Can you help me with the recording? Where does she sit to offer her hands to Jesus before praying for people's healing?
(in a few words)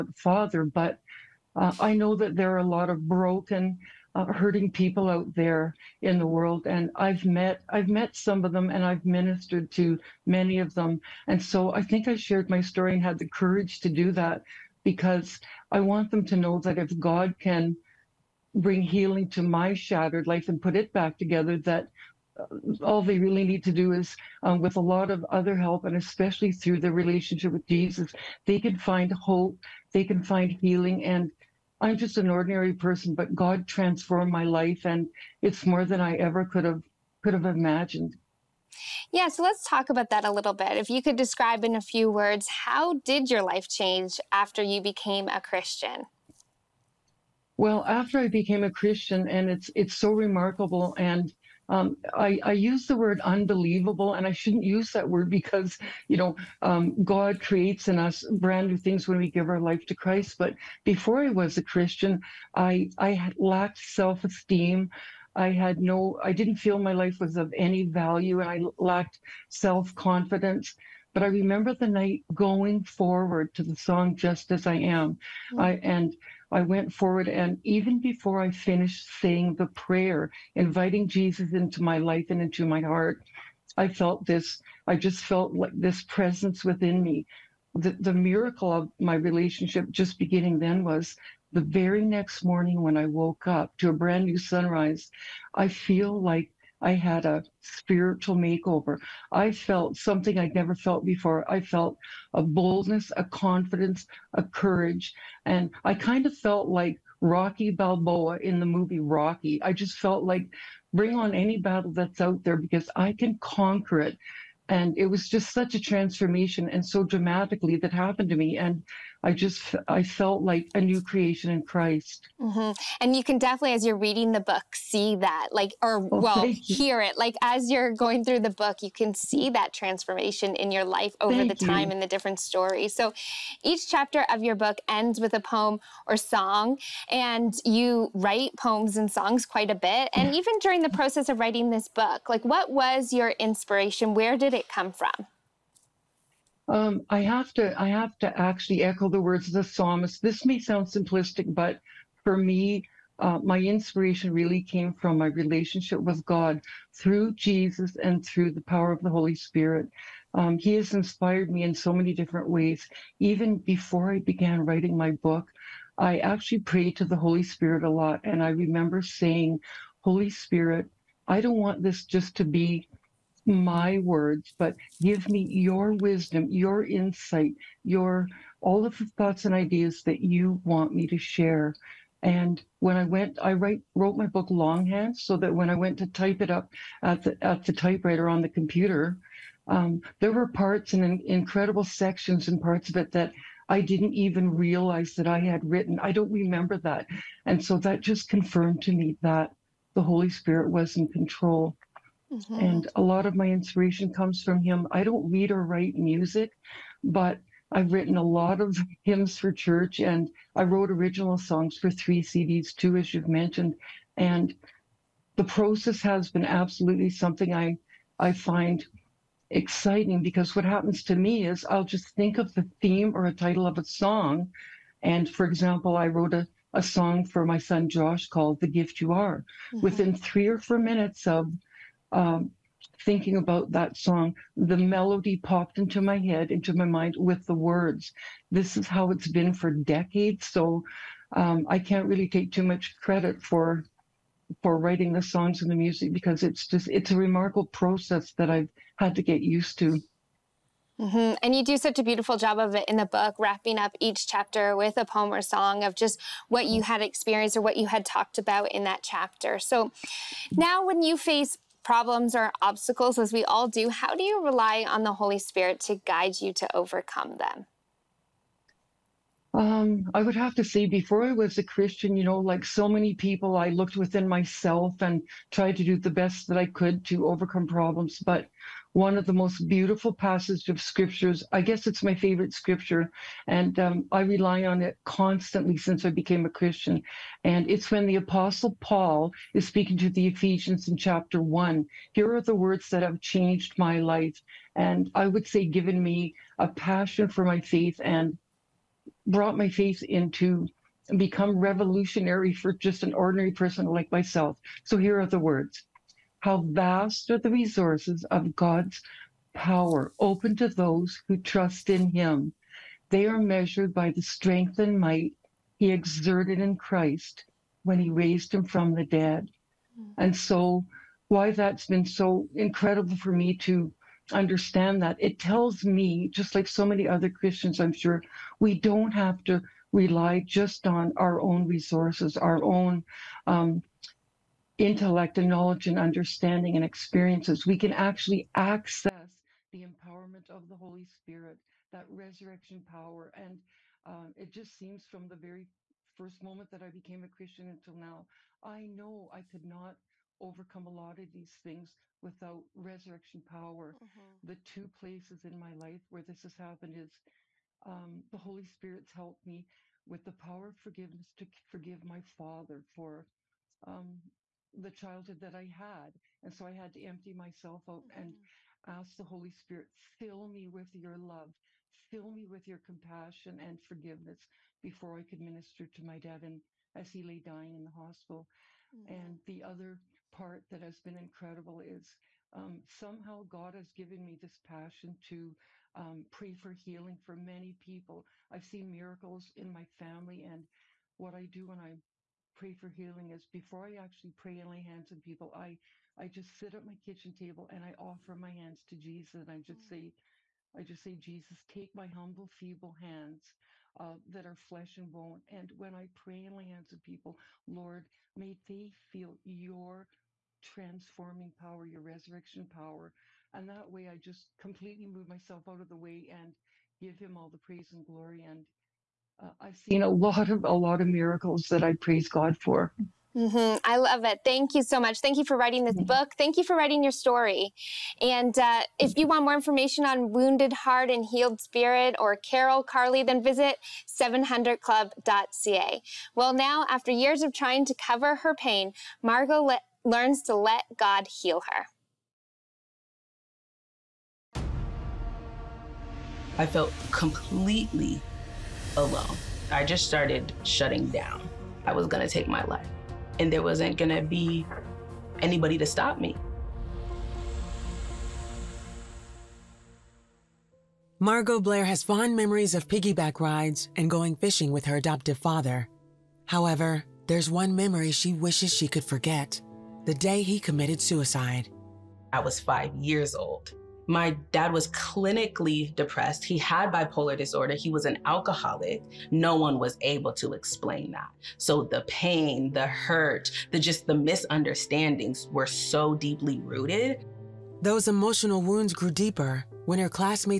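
Kitchen table.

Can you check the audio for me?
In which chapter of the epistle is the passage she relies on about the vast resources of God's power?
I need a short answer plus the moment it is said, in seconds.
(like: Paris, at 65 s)
Chapter 1, at 290 s.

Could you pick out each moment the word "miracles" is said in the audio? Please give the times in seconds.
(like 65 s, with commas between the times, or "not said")
88 s, 388 s, 421 s.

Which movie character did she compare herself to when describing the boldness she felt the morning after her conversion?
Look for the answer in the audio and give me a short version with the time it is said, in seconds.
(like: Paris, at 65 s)
Rocky Balboa, at 107 s.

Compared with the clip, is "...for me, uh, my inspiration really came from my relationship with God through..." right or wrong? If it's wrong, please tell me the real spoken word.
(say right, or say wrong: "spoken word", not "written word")
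right.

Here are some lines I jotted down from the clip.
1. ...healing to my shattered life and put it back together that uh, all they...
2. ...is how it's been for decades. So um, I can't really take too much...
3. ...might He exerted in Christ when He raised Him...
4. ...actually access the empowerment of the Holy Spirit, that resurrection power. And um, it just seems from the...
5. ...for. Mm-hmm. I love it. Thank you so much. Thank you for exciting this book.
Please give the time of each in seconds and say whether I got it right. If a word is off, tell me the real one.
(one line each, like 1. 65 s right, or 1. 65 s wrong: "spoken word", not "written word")
1. 18 s right
2. 238 s right
3. 314 s right
4. 337 s right
5. 422 s wrong: "writing", not "exciting".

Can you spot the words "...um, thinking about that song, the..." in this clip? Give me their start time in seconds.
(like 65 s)
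232 s.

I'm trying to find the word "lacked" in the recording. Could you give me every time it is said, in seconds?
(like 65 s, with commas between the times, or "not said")
63 s, 68 s.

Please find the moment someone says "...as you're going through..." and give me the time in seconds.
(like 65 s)
127 s.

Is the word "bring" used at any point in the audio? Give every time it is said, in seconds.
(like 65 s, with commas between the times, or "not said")
18 s, 110 s.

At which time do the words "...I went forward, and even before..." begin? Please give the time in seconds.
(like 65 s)
76 s.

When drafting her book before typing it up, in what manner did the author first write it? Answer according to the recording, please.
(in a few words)
Longhand.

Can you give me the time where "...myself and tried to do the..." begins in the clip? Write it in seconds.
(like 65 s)
274 s.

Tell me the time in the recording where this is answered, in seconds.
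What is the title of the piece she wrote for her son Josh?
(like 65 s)
228 s.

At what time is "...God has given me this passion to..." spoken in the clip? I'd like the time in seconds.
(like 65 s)
383 s.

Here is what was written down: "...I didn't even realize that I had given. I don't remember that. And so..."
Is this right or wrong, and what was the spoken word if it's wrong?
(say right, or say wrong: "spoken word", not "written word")
wrong: "written", not "given".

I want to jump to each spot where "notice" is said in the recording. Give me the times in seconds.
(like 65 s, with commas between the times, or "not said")
not said.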